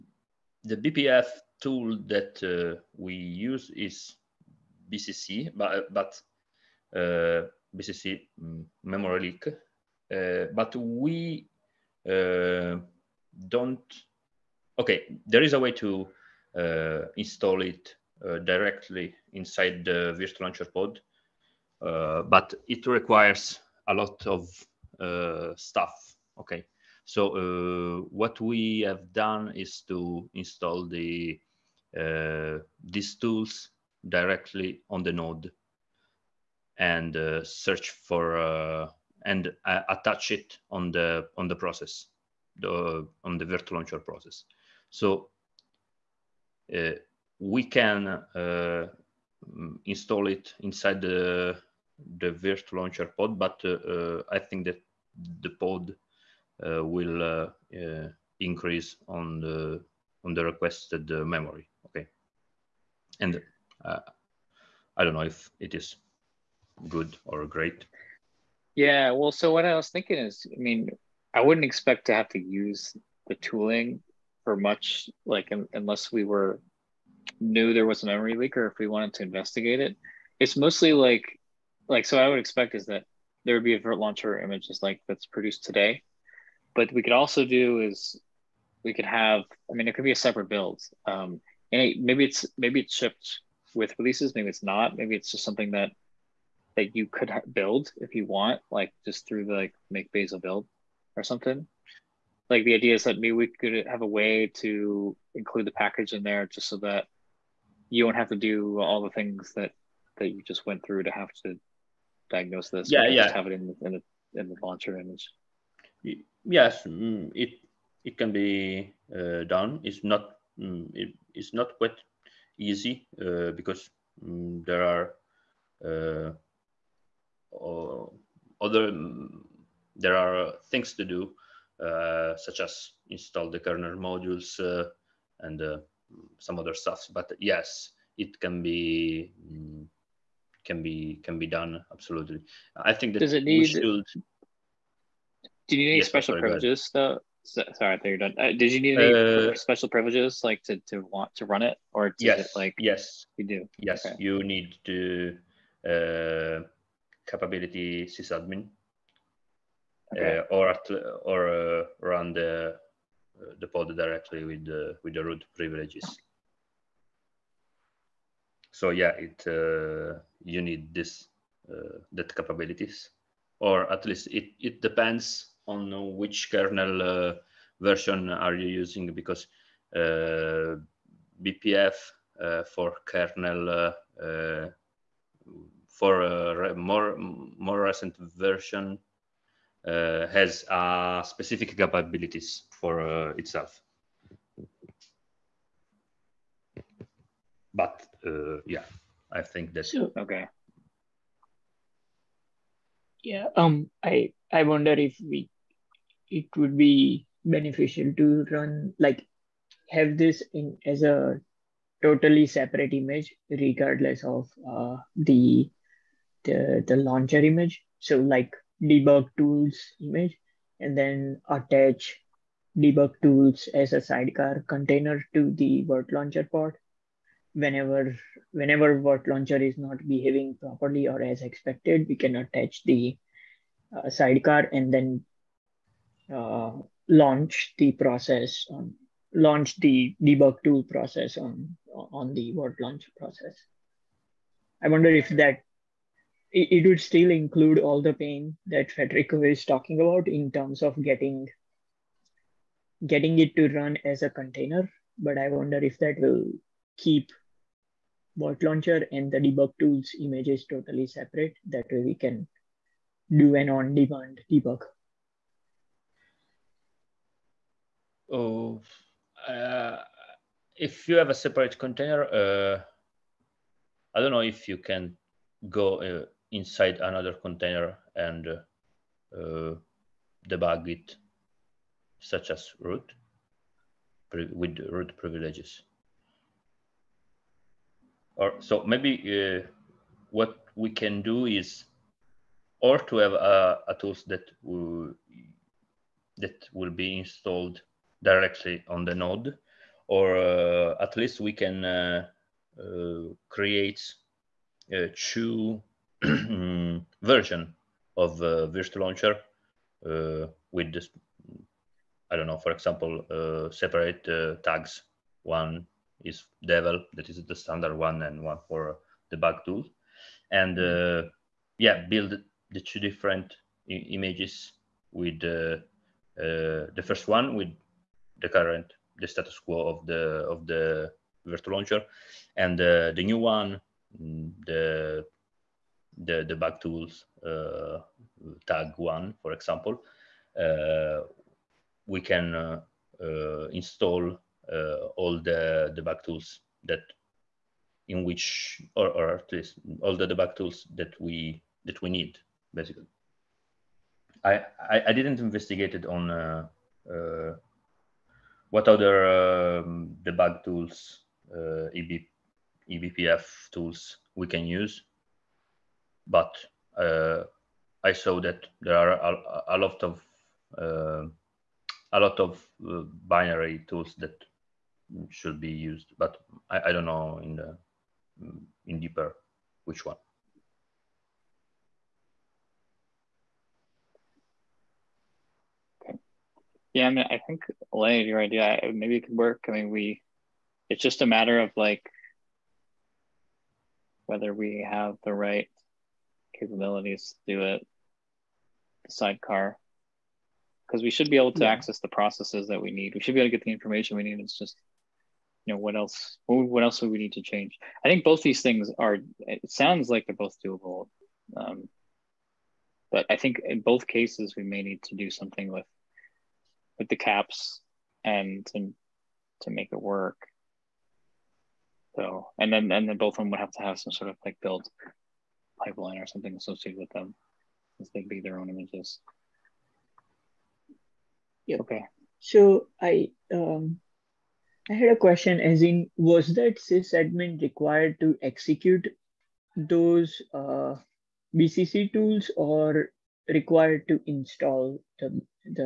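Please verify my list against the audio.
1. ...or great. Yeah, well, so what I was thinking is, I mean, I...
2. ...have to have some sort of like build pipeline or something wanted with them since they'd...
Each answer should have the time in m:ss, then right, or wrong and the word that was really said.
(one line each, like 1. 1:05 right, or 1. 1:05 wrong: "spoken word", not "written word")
1. 1:07 right
2. 7:03 wrong: "associated", not "wanted".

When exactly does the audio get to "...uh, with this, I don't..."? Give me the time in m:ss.
5:10.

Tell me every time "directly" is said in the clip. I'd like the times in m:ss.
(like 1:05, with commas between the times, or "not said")
0:18, 0:34, 2:43, 4:58.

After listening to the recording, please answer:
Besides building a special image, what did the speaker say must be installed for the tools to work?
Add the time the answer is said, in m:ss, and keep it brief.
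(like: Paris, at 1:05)
kernel modules, at 2:13.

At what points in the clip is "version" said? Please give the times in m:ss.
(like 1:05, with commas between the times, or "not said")
2:57, 3:08, 5:07.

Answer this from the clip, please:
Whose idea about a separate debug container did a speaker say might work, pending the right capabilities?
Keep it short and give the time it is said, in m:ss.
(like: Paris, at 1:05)
Lane, at 6:27.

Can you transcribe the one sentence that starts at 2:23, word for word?
do you need any yes, special sorry, privileges so, sorry, I thought you are done.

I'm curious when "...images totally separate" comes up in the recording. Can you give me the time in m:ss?
4:20.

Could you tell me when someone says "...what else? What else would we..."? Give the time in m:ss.
6:45.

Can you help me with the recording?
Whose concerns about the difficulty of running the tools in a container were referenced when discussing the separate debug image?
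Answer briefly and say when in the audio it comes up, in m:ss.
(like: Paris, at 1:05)
Federico, at 4:08.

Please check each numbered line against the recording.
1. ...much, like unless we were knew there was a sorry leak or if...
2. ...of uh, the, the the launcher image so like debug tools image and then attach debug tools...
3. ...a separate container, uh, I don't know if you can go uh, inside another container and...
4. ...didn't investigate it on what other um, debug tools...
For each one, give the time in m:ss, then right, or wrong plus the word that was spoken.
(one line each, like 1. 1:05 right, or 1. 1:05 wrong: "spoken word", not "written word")
1. 1:14 wrong: "memory", not "sorry"
2. 3:34 right
3. 4:31 right
4. 5:55 right.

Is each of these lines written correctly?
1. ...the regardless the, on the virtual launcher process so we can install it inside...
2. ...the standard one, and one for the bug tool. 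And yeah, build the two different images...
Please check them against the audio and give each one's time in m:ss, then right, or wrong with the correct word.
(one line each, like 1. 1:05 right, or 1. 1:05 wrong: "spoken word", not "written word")
1. 0:41 wrong: "process", not "regardless"
2. 5:17 right.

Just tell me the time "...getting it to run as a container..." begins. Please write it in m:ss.
4:13.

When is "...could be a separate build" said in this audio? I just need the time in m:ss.
1:29.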